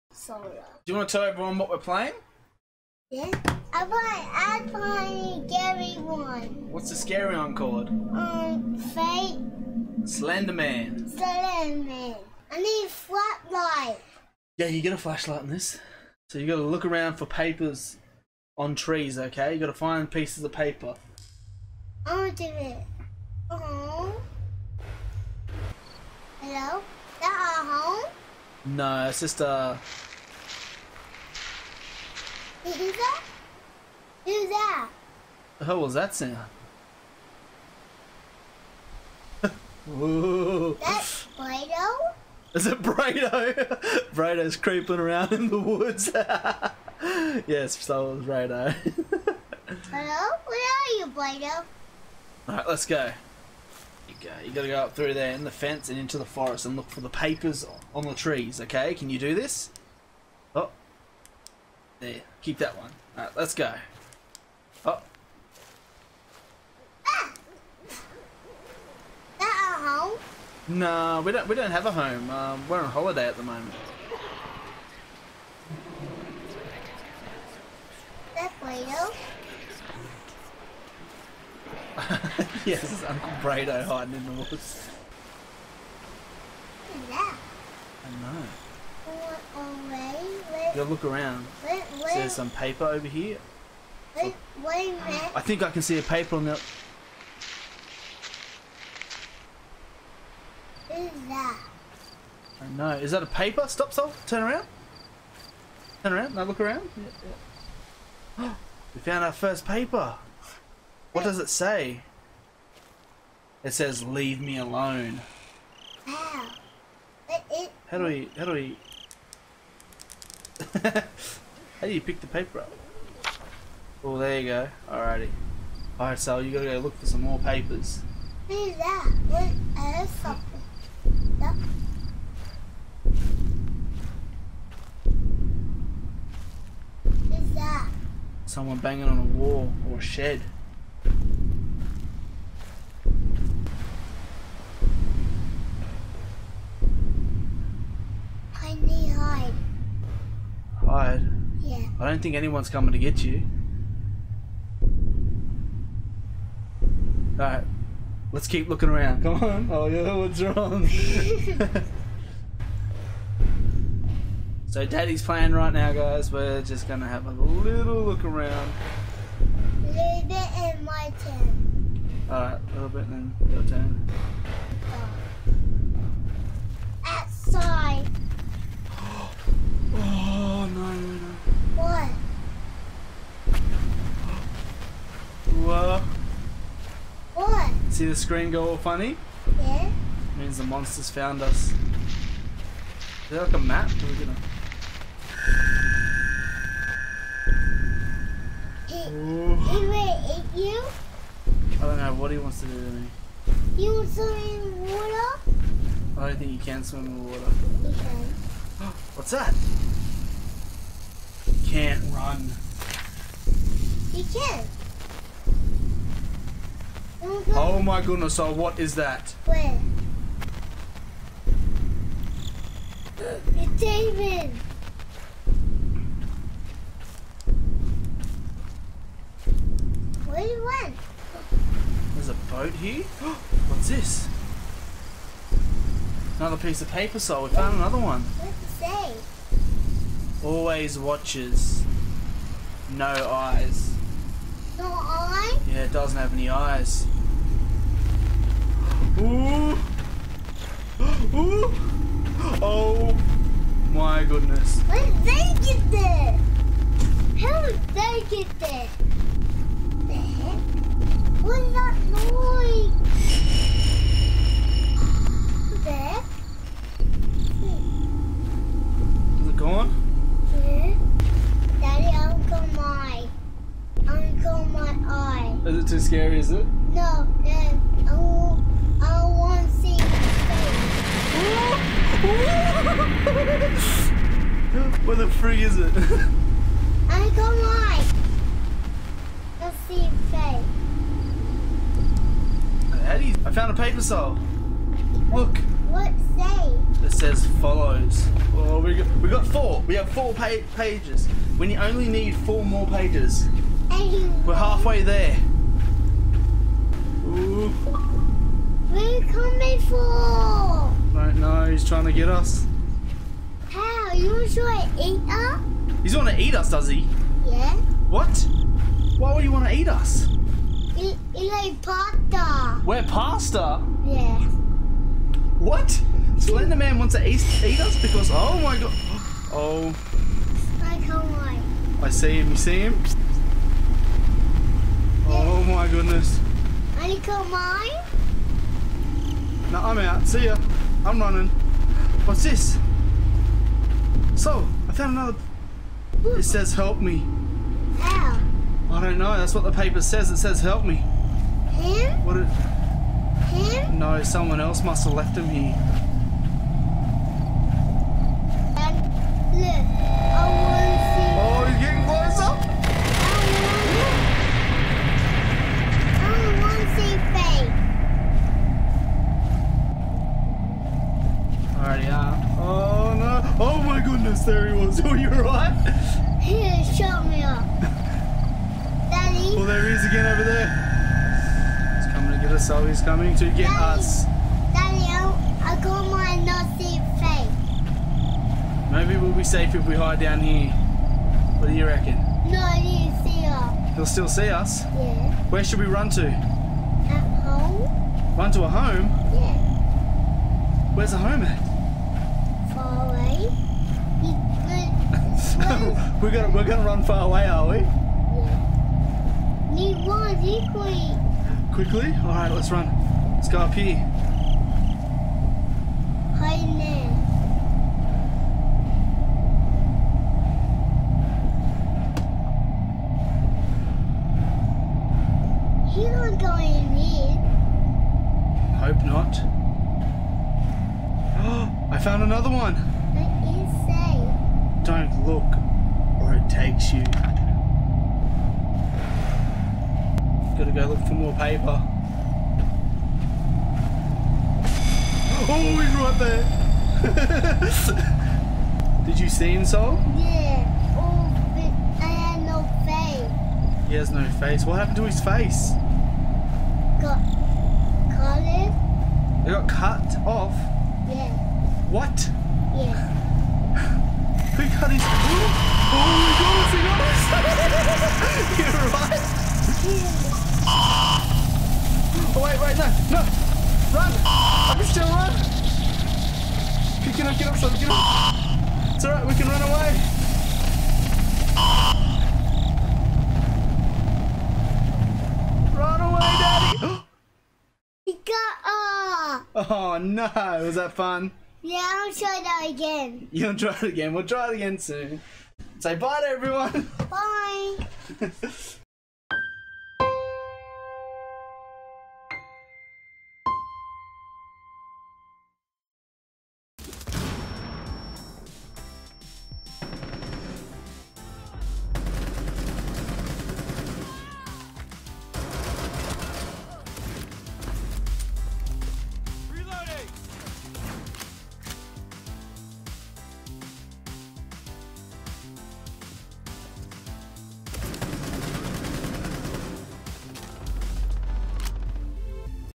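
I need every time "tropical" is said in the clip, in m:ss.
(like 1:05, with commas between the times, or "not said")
not said.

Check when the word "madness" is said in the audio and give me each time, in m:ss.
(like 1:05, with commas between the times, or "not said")
not said.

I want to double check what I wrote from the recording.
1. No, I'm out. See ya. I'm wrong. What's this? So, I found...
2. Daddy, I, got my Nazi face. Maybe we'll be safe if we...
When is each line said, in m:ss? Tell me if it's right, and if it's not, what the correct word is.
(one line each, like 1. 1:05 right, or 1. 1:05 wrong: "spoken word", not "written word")
1. 5:39 wrong: "running", not "wrong"
2. 6:24 right.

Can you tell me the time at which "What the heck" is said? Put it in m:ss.
4:20.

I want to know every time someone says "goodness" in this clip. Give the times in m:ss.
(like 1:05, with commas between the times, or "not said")
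3:38, 4:14, 5:35.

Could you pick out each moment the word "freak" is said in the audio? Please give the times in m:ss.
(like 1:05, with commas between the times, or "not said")
4:45.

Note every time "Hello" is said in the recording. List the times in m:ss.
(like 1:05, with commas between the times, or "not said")
0:26, 0:49.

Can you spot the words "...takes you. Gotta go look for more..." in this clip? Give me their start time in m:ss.
7:16.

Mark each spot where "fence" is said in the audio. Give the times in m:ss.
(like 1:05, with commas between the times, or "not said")
0:55.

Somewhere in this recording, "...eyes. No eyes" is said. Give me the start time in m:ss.
4:03.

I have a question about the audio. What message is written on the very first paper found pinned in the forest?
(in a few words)
Leave me alone.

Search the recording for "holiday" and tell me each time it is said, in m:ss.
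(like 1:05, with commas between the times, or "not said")
1:12.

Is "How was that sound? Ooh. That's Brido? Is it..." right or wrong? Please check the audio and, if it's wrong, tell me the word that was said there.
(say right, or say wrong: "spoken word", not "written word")
right.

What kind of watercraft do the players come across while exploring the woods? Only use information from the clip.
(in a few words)
A boat.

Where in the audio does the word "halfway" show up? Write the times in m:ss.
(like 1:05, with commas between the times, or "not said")
5:04.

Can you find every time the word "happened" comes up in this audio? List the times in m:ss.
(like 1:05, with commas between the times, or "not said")
7:34.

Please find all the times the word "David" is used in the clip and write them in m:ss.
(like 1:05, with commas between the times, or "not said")
3:43.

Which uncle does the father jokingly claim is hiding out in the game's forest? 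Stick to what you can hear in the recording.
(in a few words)
Uncle Bredo.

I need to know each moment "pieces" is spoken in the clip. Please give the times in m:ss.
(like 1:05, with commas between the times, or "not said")
0:20, 3:56.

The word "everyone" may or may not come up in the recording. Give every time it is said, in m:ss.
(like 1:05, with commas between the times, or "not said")
0:01, 8:16.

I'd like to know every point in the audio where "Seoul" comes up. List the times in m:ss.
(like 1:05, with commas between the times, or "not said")
1:43, 2:06, 4:54, 7:29.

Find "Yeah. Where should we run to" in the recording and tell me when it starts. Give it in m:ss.
6:34.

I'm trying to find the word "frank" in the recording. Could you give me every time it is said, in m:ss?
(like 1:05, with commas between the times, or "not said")
not said.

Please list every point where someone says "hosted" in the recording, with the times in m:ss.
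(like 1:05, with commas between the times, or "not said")
not said.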